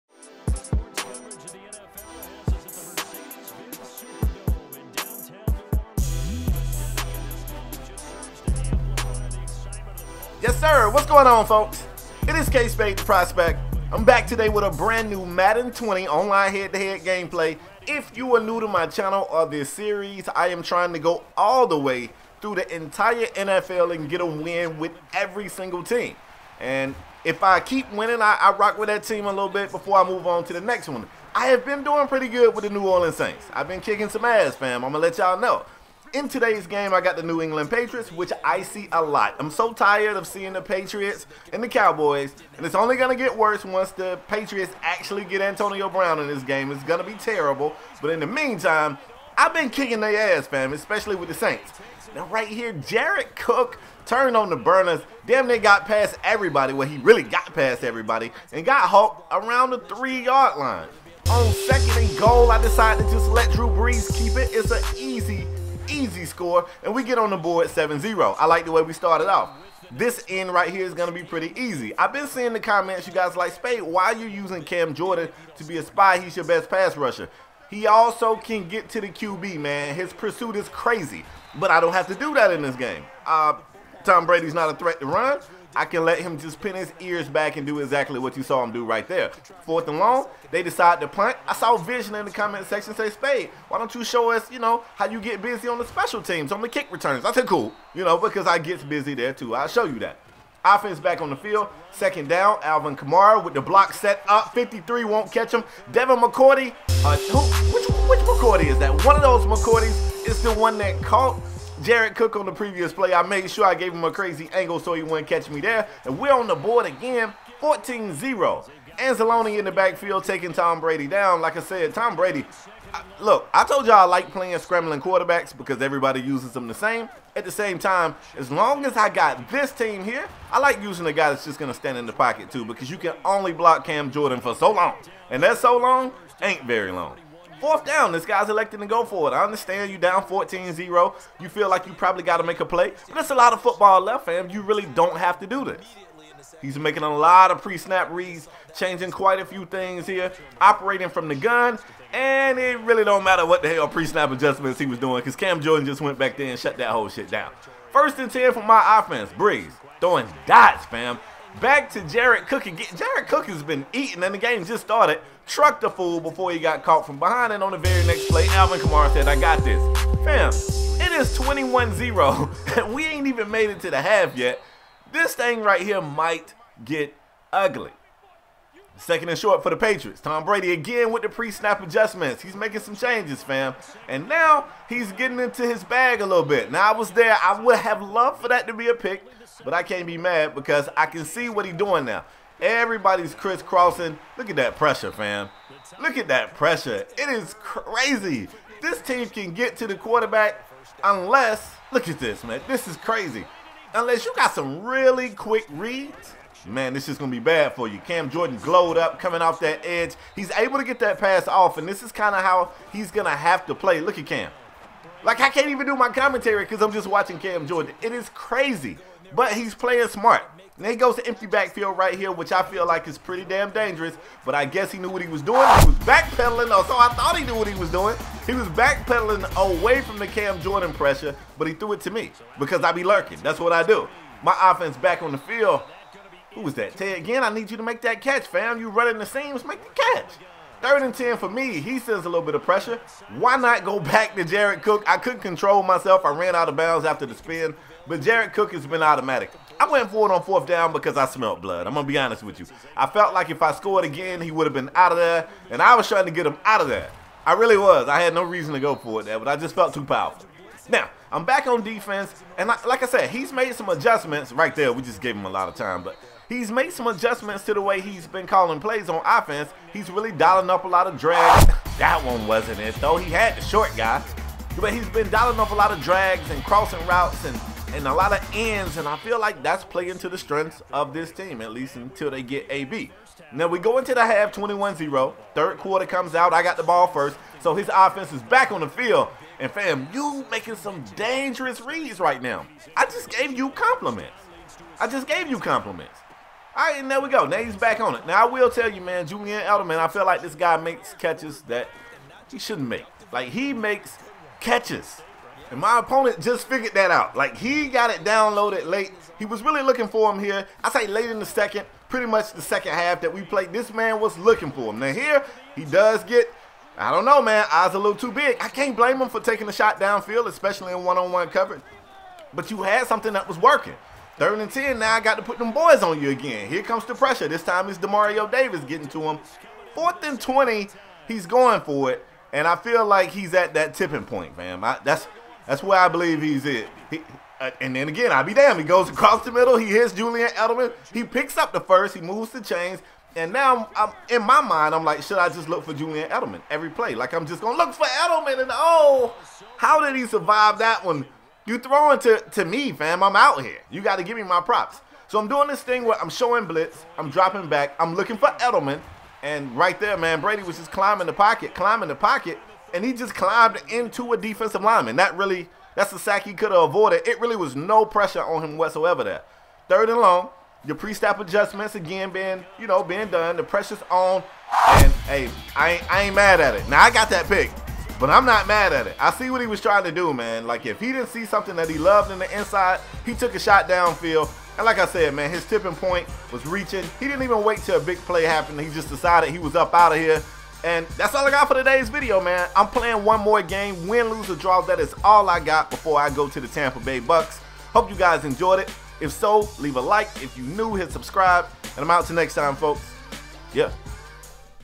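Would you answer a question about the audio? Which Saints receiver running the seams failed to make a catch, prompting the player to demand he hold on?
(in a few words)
Ted Ginn.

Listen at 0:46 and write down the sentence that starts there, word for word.
It's going to be terrible, but in the meantime, I've been kicking their ass, fam, especially with the Saints.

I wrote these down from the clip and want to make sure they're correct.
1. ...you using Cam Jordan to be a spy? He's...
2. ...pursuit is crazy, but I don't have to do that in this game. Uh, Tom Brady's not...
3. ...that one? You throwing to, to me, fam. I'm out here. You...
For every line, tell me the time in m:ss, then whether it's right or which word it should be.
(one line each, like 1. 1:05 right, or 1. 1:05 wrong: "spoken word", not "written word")
1. 1:14 right
2. 1:20 right
3. 5:50 right.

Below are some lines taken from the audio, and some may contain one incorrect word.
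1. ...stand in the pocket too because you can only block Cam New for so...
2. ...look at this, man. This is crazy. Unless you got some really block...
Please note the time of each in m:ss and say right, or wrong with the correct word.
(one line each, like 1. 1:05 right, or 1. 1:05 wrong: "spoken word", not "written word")
1. 2:11 wrong: "Jordan", not "New"
2. 3:21 wrong: "quick", not "block".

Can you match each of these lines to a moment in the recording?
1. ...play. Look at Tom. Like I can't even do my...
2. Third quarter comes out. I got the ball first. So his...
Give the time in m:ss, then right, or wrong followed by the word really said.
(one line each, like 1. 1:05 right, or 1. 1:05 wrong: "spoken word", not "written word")
1. 3:33 wrong: "Cam", not "Tom"
2. 4:45 right.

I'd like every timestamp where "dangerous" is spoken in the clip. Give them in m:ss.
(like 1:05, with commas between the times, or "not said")
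3:43, 4:51.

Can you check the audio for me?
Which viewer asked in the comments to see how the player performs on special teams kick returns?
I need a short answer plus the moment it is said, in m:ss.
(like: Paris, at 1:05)
Vision, at 1:31.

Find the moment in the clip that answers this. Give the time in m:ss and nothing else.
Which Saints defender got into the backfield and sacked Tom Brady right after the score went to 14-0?
1:58.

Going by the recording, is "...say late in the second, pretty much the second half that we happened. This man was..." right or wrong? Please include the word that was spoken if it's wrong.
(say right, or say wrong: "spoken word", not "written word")
wrong: "played", not "happened".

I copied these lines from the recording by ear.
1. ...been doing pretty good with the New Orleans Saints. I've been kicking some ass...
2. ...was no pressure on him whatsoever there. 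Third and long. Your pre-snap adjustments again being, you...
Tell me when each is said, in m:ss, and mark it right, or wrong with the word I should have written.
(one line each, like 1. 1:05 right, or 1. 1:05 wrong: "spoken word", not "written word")
1. 0:31 right
2. 6:07 right.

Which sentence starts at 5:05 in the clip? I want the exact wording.
And my opponent just figured that out.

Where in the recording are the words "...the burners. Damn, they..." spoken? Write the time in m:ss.
0:54.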